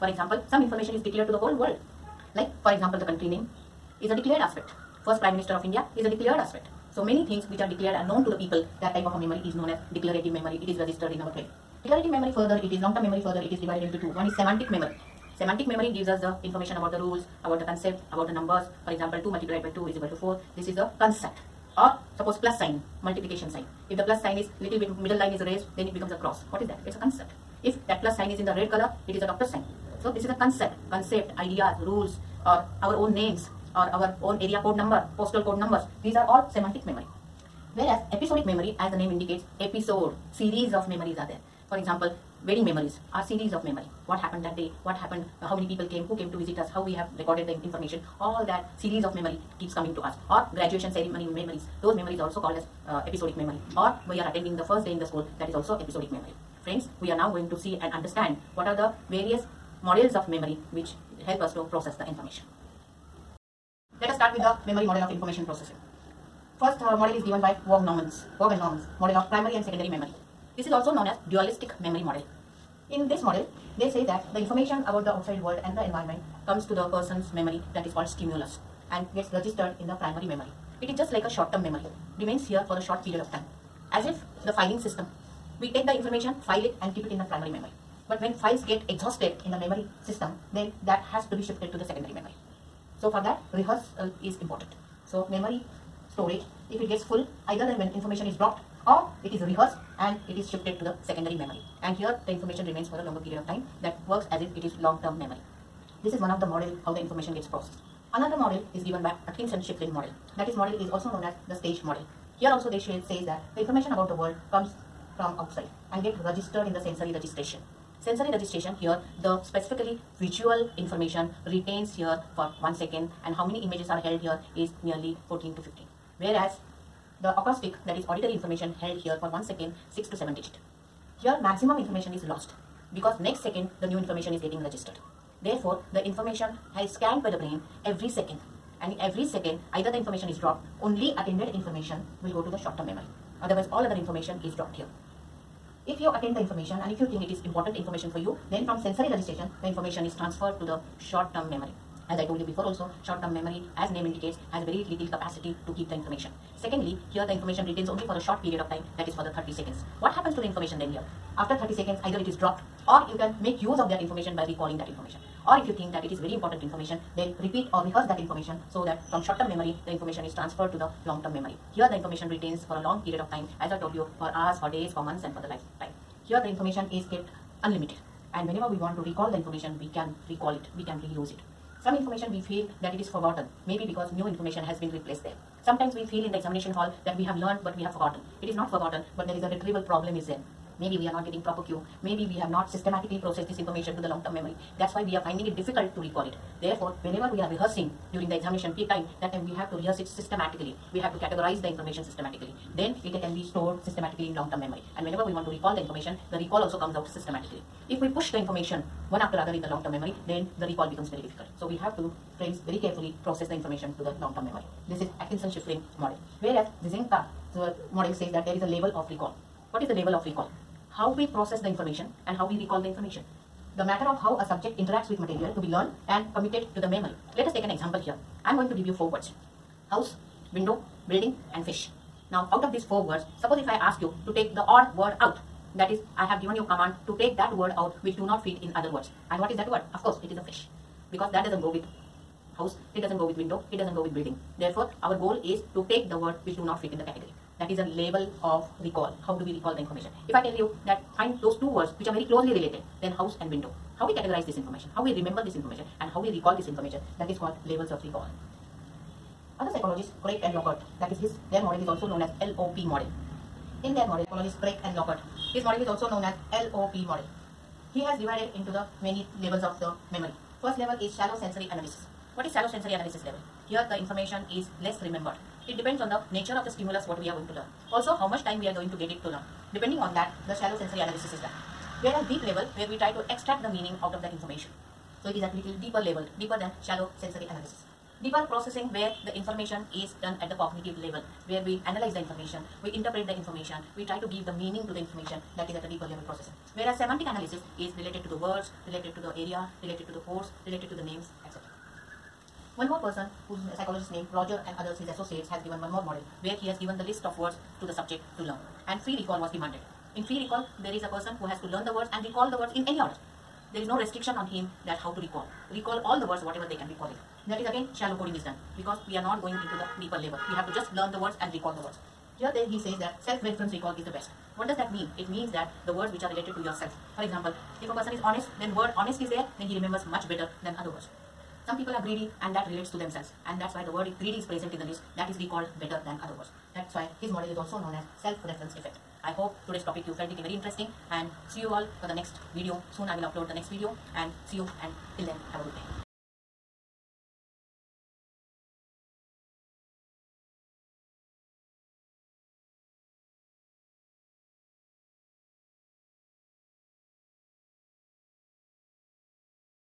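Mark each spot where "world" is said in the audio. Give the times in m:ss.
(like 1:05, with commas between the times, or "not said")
0:01, 1:15, 1:54.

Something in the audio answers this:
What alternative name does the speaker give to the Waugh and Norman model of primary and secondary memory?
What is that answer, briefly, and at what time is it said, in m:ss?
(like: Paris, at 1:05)
Dualistic memory model, at 1:11.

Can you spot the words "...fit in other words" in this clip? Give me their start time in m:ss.
3:58.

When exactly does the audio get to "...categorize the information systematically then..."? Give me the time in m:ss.
3:21.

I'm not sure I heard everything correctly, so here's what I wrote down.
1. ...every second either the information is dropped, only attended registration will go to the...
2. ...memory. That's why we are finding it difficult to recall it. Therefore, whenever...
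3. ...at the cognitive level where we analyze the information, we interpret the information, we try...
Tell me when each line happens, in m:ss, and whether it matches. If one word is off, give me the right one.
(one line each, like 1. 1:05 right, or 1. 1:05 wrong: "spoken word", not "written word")
1. 2:18 wrong: "information", not "registration"
2. 3:14 right
3. 4:50 right.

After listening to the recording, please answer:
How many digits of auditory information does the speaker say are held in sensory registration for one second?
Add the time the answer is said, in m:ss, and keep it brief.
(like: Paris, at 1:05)
6 to 7, at 2:09.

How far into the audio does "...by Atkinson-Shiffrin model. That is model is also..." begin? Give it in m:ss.
1:49.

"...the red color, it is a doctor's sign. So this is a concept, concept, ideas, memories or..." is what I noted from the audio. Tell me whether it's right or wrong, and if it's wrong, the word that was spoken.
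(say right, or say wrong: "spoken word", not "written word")
wrong: "rules", not "memories".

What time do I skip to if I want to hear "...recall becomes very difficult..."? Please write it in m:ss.
3:30.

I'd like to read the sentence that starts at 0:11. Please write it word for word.
Declarative memory further, it is long-term memory further, it is divided into two.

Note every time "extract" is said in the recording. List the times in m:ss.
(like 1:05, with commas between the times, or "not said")
4:43.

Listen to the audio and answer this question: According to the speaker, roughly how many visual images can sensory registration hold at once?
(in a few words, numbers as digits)
14 to 15.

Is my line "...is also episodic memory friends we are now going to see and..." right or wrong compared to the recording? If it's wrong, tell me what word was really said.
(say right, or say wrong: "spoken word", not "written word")
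right.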